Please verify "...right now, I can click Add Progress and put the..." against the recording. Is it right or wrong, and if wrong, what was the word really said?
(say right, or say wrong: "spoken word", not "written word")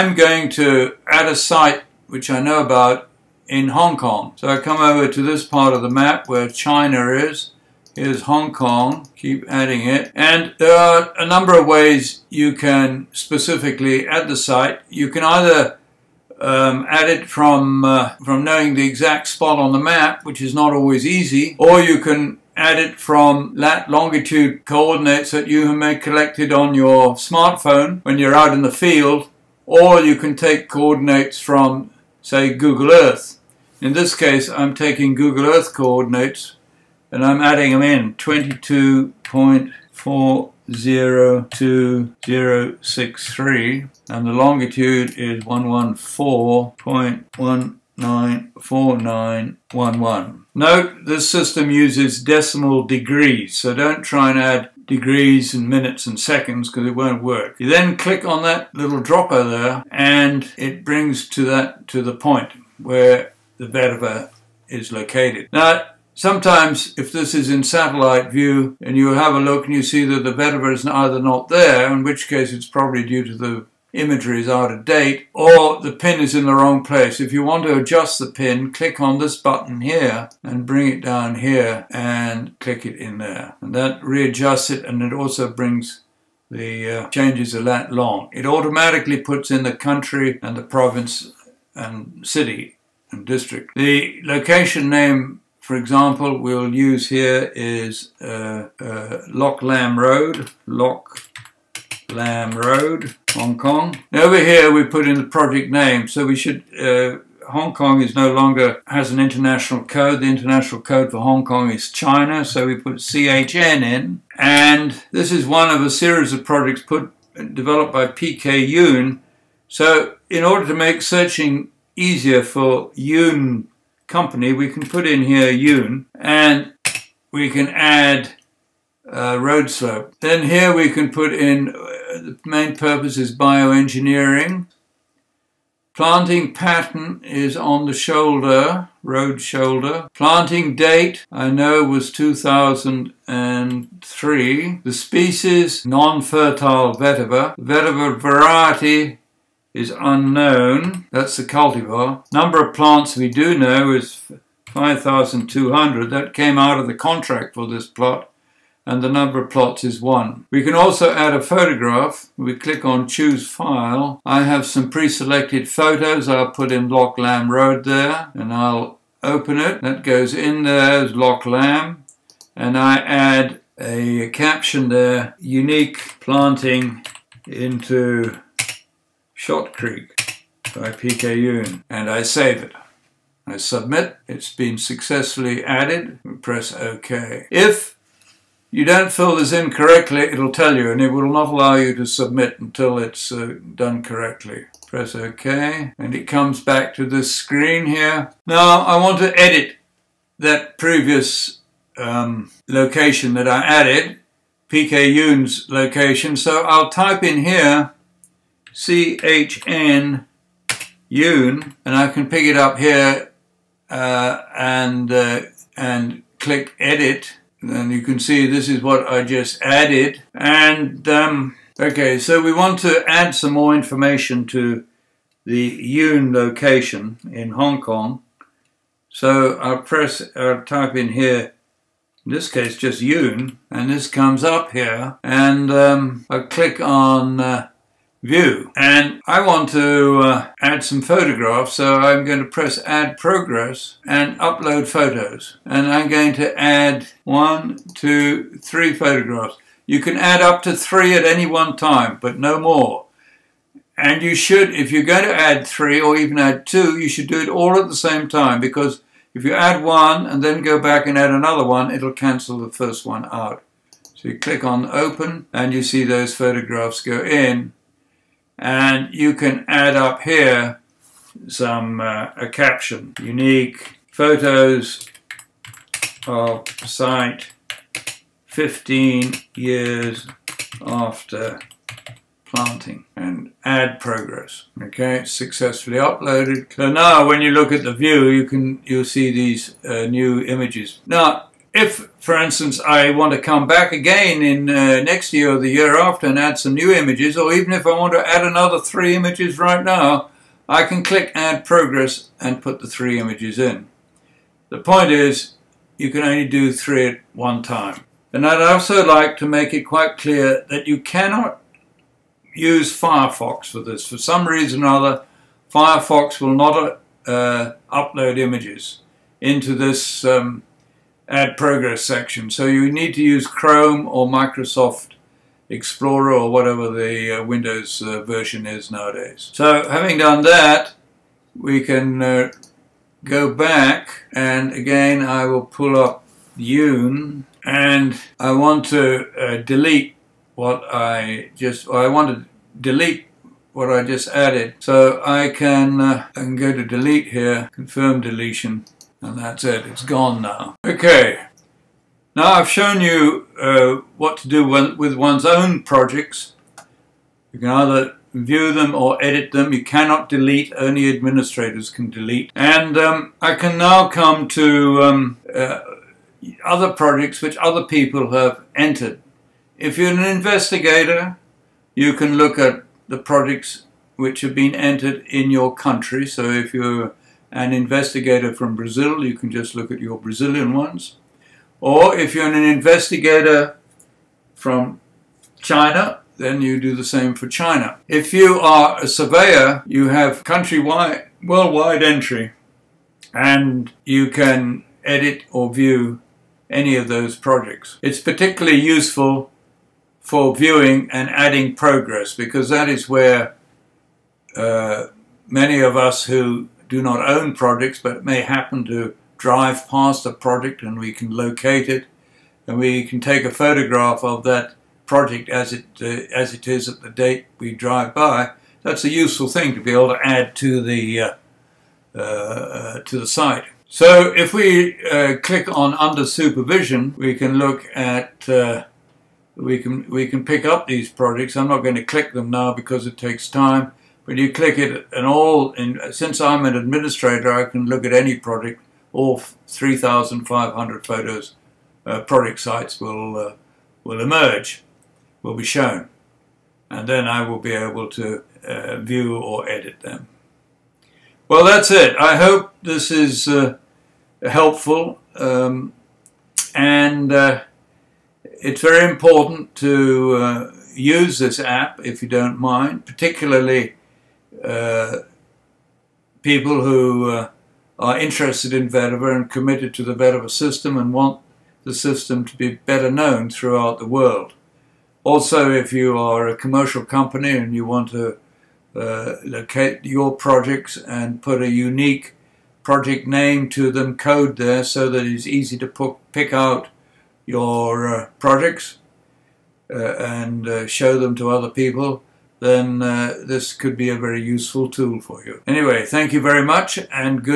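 right.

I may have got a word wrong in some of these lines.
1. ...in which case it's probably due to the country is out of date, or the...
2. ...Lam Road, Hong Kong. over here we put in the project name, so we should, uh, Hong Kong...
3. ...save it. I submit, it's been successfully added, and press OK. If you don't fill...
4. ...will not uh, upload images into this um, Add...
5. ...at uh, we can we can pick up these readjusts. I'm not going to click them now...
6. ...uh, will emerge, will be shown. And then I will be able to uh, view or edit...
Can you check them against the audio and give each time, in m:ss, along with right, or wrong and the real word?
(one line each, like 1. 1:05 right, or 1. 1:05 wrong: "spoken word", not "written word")
1. 1:11 wrong: "imagery", not "country"
2. 1:42 right
3. 3:02 right
4. 5:16 right
5. 7:07 wrong: "projects", not "readjusts"
6. 7:23 right.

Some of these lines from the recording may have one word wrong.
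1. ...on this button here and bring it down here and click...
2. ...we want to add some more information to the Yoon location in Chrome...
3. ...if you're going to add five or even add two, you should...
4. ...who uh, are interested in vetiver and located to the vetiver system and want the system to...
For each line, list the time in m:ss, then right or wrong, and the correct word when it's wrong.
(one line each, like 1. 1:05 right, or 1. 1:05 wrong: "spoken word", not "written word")
1. 1:18 right
2. 3:42 wrong: "Hong", not "Chrome"
3. 4:14 wrong: "three", not "five"
4. 7:46 wrong: "committed", not "located".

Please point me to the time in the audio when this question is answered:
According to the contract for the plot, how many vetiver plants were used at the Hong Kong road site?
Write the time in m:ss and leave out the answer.
2:34.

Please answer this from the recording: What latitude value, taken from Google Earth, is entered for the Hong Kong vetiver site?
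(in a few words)
22.402063.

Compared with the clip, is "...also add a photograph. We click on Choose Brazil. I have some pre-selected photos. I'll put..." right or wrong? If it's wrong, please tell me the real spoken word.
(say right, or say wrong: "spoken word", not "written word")
wrong: "File", not "Brazil".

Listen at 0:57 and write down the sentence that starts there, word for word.
You then click on that little dropper there and it brings to that to the point where the vetiver is located.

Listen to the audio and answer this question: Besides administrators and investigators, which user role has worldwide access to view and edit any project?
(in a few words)
Surveyor.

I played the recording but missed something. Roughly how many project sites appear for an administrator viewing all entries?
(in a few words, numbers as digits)
3,500.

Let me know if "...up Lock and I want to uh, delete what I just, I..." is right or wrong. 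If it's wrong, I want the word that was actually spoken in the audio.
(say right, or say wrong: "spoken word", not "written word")
wrong: "Yoon", not "Lock".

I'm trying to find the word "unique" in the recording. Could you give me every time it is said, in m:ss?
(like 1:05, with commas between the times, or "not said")
2:55, 4:33, 8:01.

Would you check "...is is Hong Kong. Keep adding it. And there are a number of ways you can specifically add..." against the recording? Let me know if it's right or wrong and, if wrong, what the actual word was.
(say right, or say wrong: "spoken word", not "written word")
right.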